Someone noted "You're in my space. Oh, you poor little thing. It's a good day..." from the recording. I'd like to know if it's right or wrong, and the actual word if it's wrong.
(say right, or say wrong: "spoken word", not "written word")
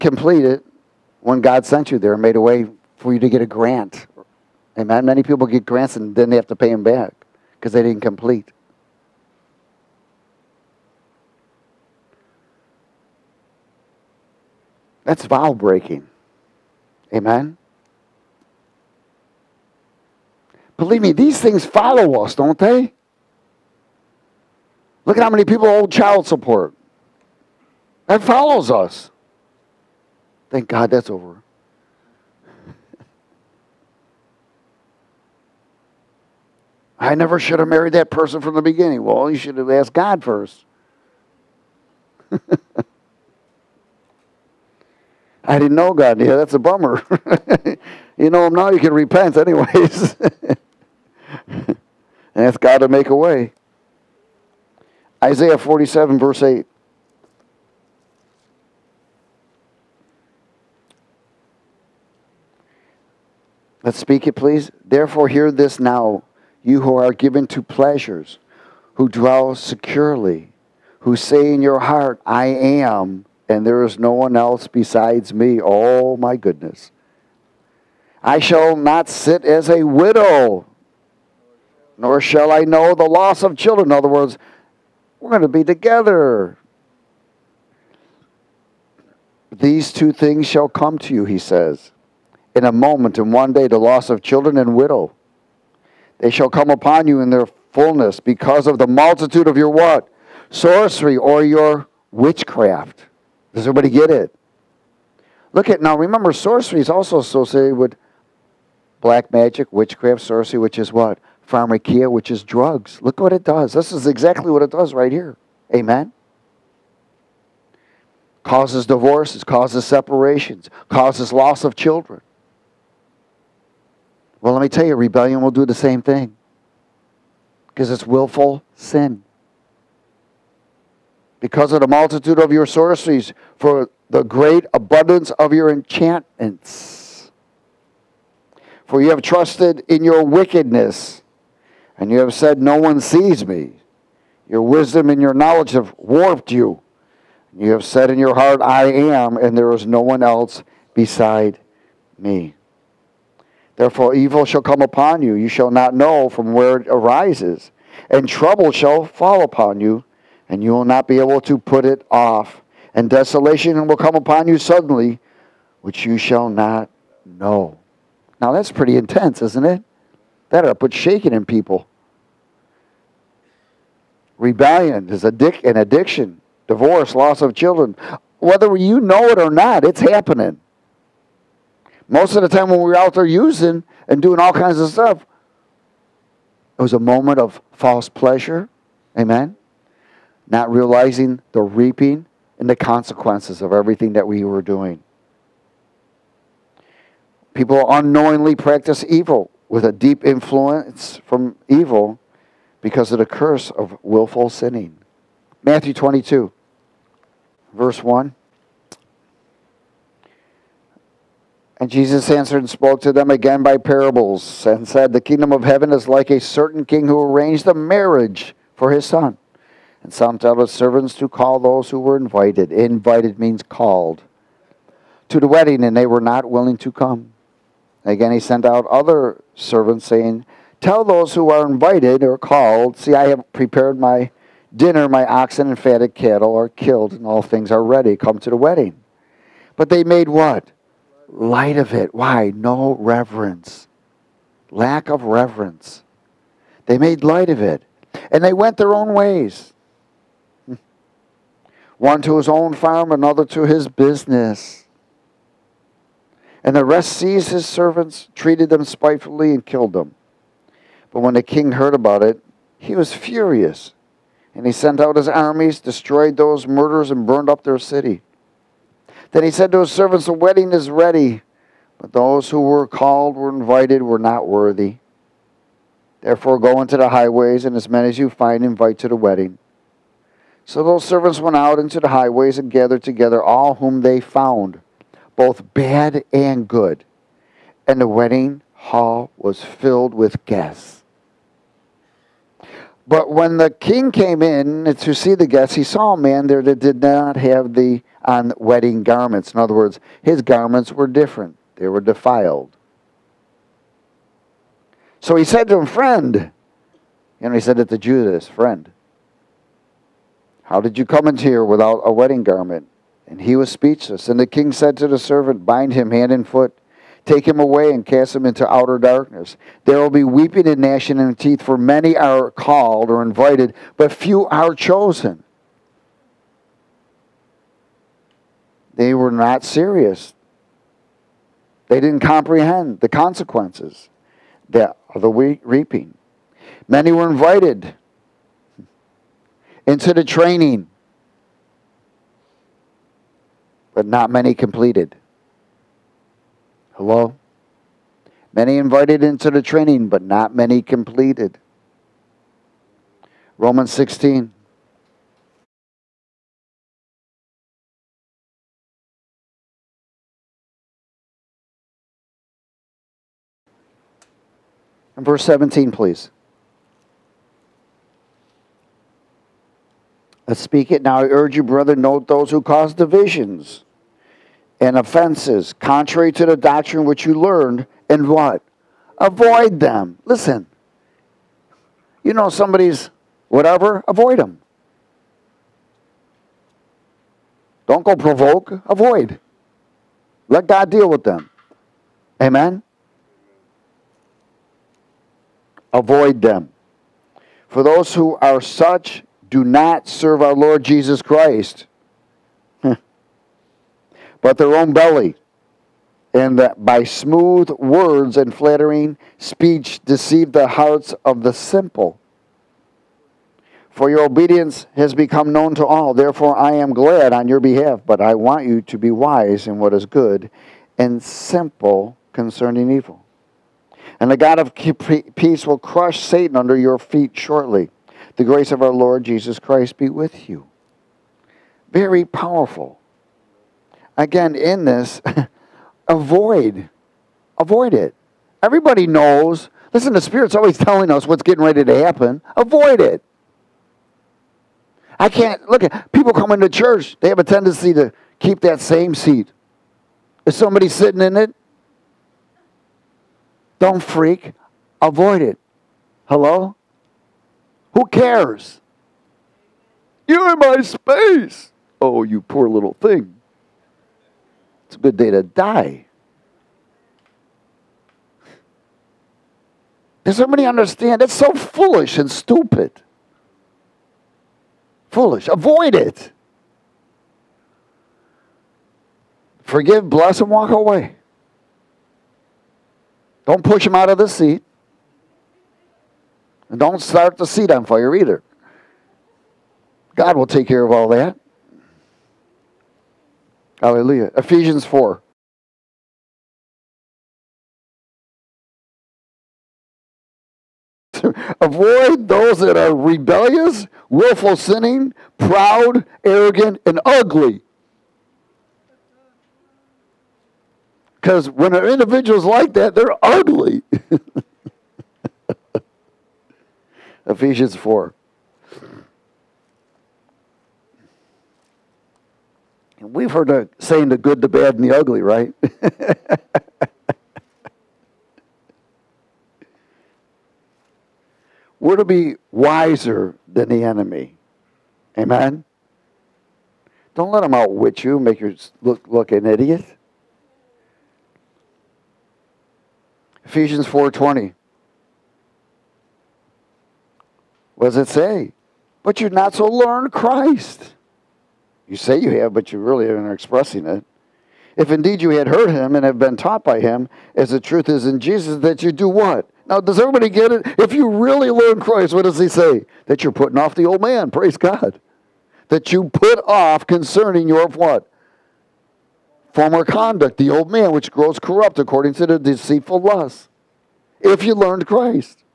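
right.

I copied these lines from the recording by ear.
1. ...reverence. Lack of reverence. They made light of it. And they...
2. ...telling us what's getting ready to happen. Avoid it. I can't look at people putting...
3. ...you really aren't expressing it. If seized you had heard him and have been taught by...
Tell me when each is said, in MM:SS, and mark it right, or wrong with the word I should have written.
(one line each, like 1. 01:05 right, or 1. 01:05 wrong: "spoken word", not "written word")
1. 04:02 right
2. 07:20 wrong: "coming", not "putting"
3. 09:12 wrong: "indeed", not "seized".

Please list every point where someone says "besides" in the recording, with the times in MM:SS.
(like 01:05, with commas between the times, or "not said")
01:14, 02:30.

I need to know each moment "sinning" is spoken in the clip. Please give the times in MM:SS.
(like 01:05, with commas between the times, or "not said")
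03:24, 08:24.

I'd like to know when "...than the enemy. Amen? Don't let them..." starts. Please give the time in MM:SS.
08:53.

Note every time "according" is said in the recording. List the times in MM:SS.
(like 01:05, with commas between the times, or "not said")
09:31.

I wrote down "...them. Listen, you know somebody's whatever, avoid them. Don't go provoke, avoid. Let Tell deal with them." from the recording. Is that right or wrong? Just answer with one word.
wrong.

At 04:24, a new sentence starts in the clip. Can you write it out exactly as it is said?
And he sent out his armies, destroyed those murderers, and burned up their city.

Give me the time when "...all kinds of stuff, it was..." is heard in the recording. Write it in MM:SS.
03:04.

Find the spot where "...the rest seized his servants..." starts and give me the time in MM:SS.
04:16.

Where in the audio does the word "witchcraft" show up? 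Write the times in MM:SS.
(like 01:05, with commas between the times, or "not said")
01:42, 01:49.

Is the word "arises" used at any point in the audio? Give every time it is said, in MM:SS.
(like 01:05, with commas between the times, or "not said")
02:36.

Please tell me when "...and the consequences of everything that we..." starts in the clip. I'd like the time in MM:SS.
03:12.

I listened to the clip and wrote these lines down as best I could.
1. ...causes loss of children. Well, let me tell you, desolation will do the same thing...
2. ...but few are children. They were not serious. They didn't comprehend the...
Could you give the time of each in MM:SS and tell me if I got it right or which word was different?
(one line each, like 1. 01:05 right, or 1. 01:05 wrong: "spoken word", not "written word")
1. 02:00 wrong: "rebellion", not "desolation"
2. 05:23 wrong: "chosen", not "children".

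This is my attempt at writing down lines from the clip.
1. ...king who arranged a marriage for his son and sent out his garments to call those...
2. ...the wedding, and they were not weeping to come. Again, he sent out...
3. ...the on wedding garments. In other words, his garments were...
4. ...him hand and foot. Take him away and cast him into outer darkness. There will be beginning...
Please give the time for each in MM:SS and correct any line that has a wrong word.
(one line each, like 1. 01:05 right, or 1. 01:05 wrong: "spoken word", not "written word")
1. 03:36 wrong: "servants", not "garments"
2. 03:45 wrong: "willing", not "weeping"
3. 04:57 right
4. 05:15 wrong: "weeping", not "beginning".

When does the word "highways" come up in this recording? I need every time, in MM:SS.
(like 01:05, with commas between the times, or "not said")
04:37, 04:42.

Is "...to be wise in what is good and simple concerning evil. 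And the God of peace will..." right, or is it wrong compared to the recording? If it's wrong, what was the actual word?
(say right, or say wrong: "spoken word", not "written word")
right.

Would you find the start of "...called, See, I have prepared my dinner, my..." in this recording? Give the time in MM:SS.
03:52.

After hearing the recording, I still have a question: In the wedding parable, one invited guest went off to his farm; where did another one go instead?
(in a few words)
his business.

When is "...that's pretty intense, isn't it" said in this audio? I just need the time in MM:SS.
02:48.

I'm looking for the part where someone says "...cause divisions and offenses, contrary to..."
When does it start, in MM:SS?
06:12.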